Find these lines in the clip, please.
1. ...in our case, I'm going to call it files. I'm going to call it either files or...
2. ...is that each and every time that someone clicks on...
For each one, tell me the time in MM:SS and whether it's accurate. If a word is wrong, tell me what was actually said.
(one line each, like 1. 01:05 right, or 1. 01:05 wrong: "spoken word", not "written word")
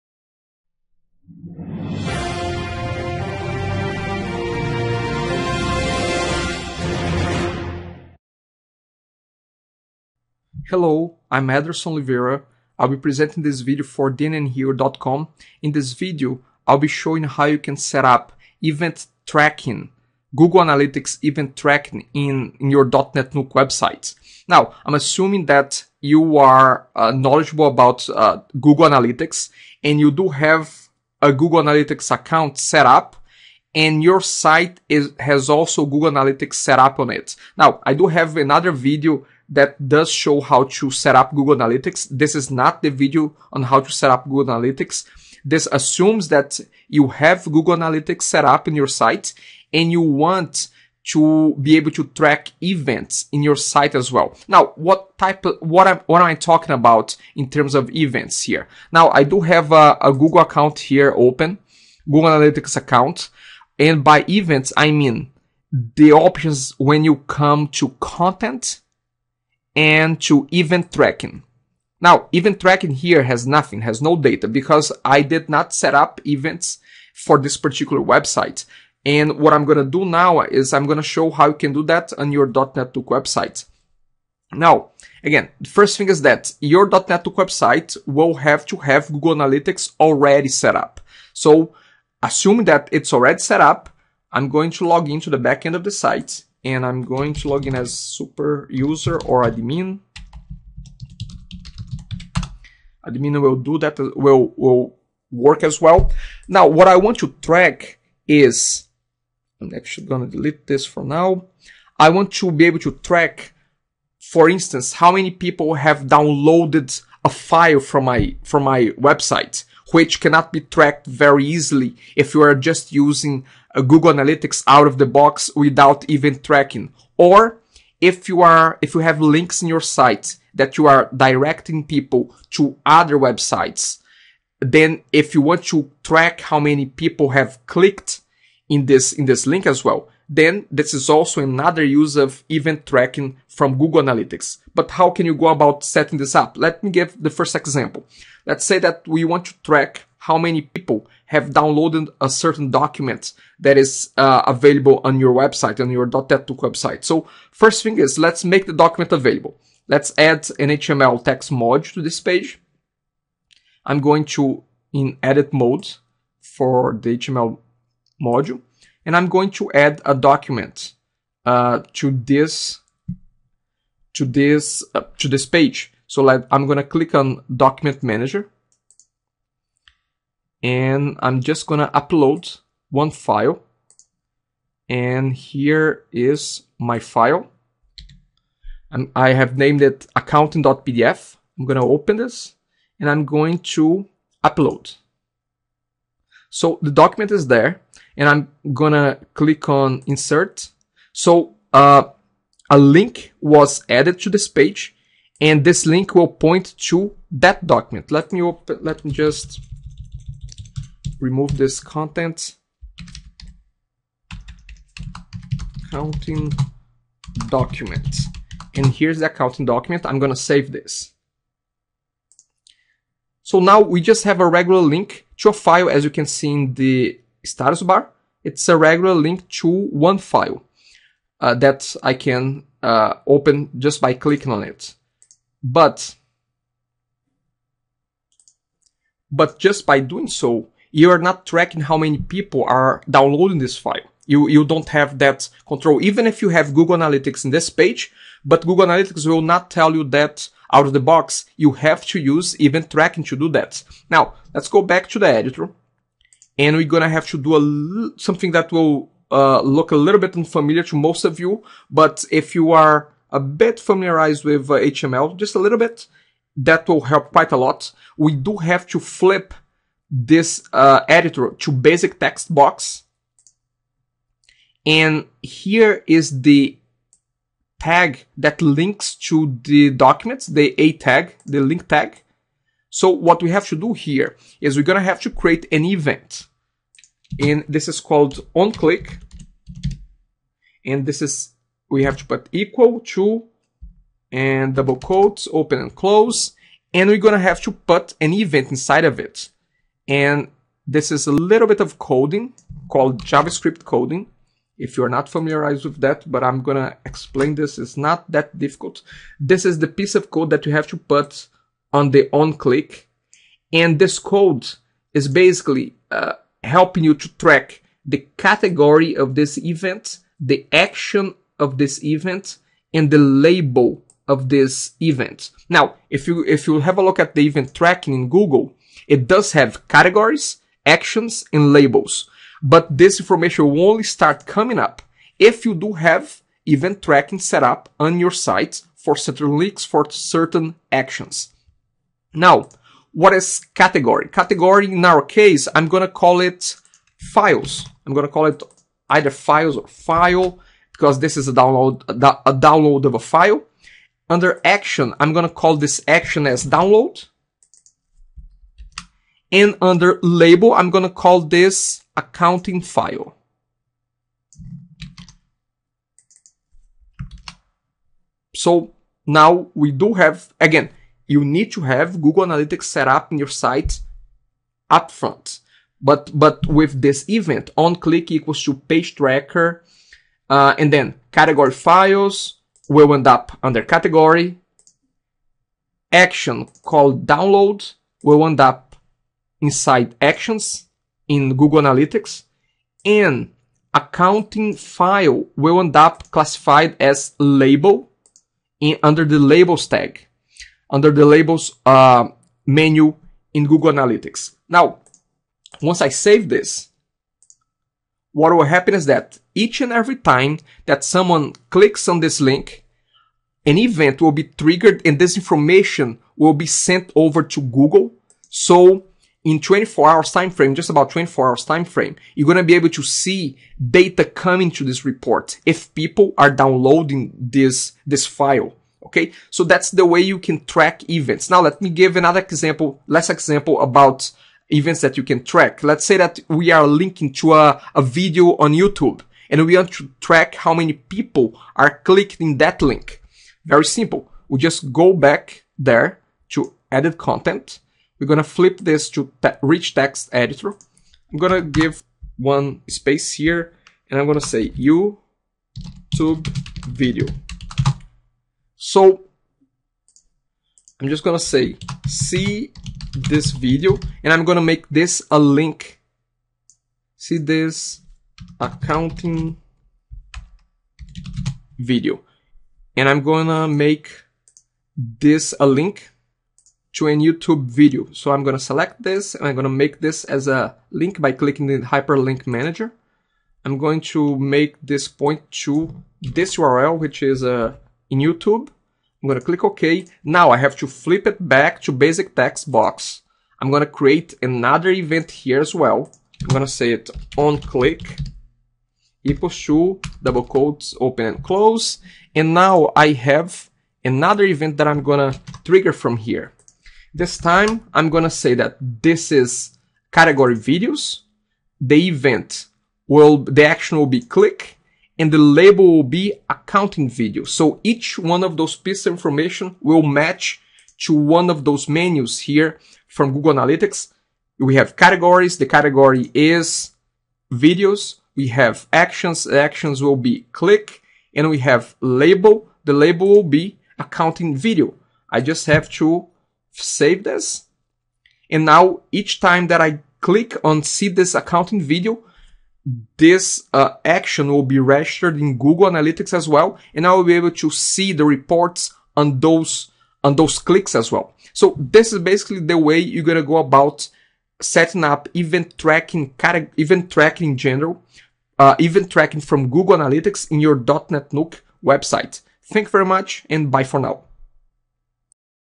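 1. 05:44 right
2. 06:48 right.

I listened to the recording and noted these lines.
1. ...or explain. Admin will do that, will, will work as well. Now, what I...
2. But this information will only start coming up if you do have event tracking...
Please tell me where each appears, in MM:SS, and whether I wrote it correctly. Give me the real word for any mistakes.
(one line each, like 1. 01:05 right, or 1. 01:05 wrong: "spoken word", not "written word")
1. 01:39 wrong: "admin", not "explain"
2. 05:32 right.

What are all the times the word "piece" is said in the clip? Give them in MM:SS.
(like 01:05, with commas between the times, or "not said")
05:09, 08:38.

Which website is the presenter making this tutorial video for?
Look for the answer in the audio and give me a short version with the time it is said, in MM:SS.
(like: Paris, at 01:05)
dnnhero.com, at 00:14.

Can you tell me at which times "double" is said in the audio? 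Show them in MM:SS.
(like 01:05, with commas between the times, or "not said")
04:54, 08:20.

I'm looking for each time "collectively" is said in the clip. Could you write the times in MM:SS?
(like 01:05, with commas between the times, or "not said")
not said.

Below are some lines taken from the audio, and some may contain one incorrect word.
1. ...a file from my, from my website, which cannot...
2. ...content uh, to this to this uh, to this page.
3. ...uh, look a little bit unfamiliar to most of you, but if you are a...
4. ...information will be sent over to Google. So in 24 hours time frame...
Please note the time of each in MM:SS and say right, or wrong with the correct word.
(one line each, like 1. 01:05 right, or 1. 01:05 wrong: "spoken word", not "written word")
1. 01:57 right
2. 02:50 wrong: "document", not "content"
3. 04:19 right
4. 06:55 right.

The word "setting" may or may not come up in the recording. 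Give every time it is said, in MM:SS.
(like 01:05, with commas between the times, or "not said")
02:25, 09:14.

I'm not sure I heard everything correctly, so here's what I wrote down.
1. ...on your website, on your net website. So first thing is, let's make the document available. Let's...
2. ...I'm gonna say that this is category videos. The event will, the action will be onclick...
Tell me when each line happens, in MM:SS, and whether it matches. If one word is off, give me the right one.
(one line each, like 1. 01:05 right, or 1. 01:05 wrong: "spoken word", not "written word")
1. 02:35 right
2. 08:27 wrong: "click", not "onclick".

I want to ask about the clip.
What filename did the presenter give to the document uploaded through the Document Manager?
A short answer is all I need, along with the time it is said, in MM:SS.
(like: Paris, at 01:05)
accounting.pdf, at 03:10.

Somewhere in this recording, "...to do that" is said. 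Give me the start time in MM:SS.
04:13.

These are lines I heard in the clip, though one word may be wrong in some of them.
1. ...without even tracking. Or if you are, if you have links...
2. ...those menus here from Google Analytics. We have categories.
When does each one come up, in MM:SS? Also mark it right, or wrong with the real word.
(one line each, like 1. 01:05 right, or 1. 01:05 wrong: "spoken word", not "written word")
1. 02:05 right
2. 08:41 right.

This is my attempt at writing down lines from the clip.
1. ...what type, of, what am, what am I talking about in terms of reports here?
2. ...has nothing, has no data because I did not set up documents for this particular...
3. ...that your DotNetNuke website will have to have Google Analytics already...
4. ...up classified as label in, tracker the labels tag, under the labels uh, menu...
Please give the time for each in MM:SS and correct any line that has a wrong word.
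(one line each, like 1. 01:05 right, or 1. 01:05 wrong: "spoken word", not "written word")
1. 00:54 wrong: "events", not "reports"
2. 01:13 wrong: "events", not "documents"
3. 01:26 right
4. 06:35 wrong: "under", not "tracker".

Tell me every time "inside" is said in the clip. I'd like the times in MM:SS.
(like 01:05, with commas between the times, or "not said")
04:58, 06:29.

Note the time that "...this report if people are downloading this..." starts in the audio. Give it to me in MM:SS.
07:04.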